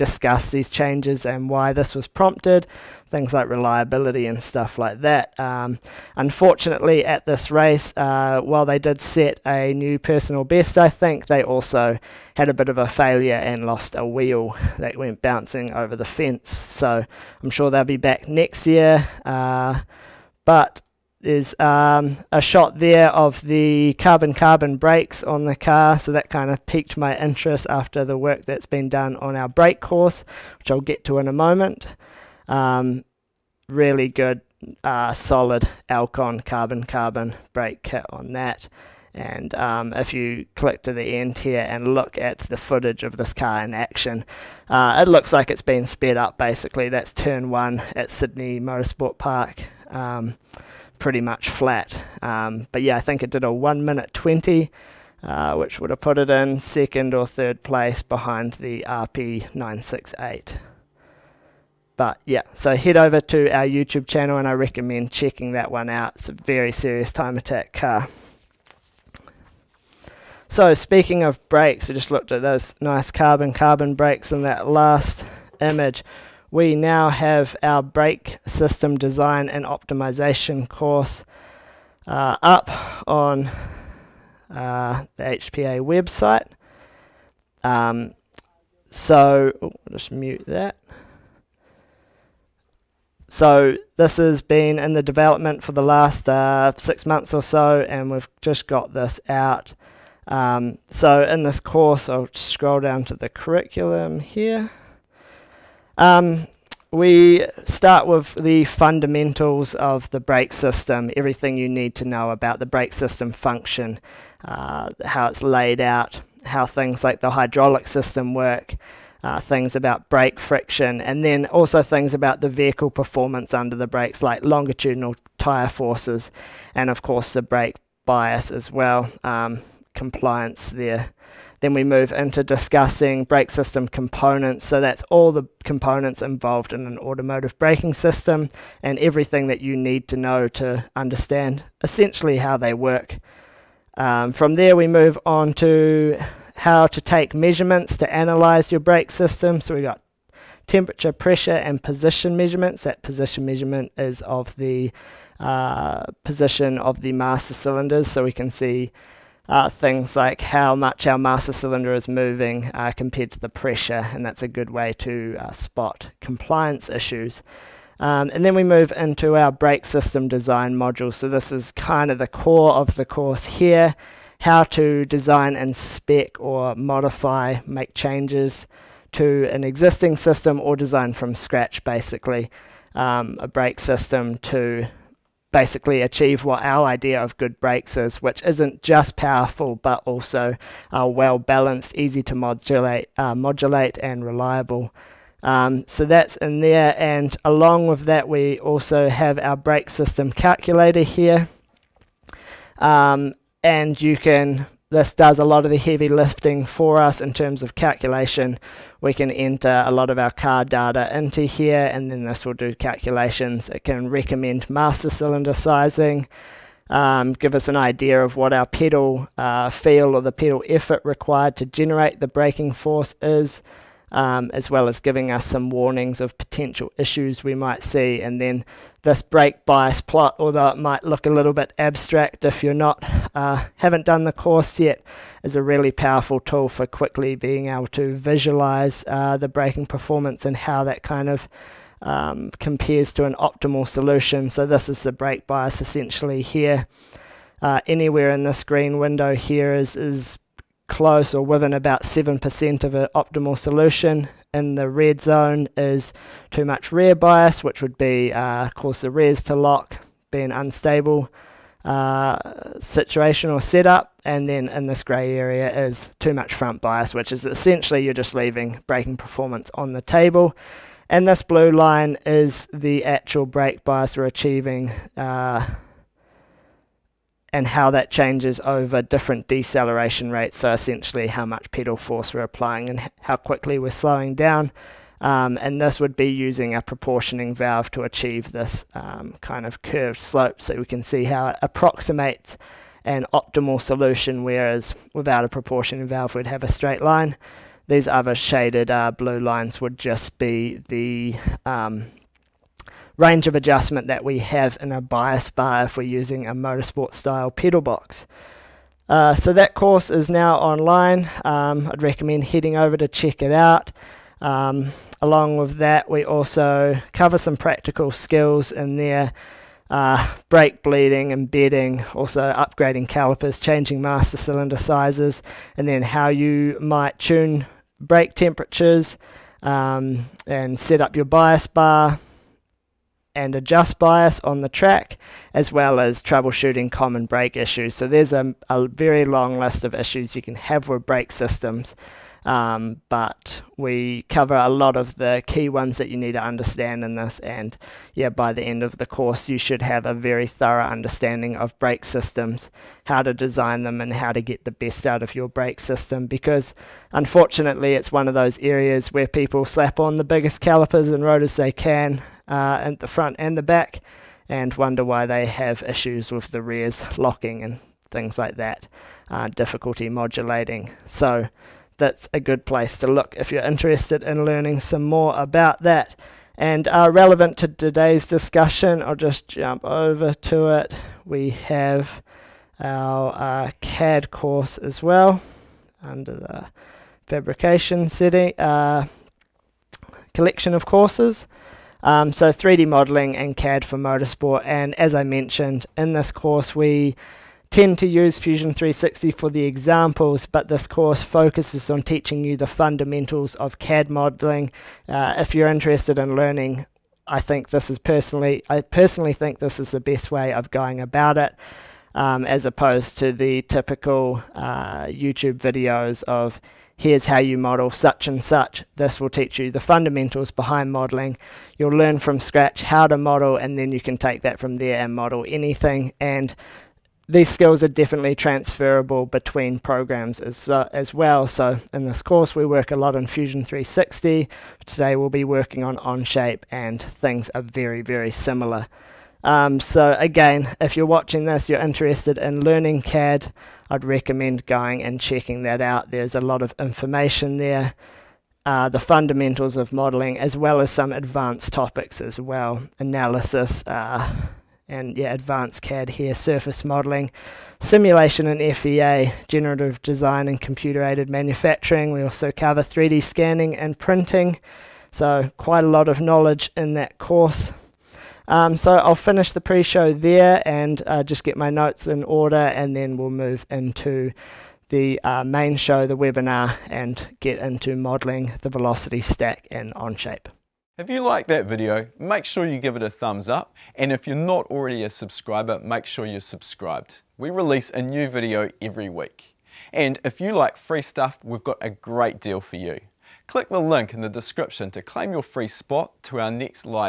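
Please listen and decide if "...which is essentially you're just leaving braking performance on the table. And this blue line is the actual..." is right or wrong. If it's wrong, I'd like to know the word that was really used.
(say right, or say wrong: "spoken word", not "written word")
right.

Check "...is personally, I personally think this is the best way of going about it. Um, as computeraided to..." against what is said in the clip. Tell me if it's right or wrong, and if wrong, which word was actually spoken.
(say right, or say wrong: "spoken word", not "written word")
wrong: "opposed", not "computeraided".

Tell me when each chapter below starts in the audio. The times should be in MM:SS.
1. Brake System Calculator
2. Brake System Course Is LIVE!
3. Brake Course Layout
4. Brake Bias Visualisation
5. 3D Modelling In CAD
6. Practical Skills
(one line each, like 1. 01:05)
1. 03:18
2. 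01:11
3. 01:41
4. 04:01
5. 06:21
6. 05:17.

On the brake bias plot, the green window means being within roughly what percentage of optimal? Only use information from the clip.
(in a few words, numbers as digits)
7%.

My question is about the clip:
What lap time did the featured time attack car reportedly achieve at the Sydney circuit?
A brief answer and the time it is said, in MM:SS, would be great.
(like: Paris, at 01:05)
1 minute 20, at 00:53.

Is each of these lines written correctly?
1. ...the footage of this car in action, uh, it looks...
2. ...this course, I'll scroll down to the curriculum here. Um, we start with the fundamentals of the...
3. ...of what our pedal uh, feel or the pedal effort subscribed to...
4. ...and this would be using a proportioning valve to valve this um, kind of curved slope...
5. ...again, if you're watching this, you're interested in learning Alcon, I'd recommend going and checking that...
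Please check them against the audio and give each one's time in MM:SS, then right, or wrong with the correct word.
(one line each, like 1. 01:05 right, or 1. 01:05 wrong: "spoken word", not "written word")
1. 00:42 right
2. 01:41 right
3. 03:38 wrong: "required", not "subscribed"
4. 04:45 wrong: "achieve", not "valve"
5. 07:20 wrong: "CAD", not "Alcon".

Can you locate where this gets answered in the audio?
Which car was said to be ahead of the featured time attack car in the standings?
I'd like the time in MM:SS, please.
00:58.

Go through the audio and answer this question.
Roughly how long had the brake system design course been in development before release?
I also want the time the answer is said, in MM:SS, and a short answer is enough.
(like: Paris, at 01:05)
6 months, at 01:36.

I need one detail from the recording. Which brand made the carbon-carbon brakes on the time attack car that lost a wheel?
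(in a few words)
Alcon.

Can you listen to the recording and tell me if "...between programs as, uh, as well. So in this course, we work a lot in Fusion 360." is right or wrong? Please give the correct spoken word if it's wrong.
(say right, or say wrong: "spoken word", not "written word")
right.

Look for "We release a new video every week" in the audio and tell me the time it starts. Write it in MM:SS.
08:07.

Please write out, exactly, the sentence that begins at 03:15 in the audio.
Um, so that's in there, and along with that, we also have our brake system calculator here.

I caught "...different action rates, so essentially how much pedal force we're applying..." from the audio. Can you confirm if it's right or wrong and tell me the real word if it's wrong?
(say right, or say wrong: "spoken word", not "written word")
wrong: "deceleration", not "action".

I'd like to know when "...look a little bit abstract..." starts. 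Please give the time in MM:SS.
03:51.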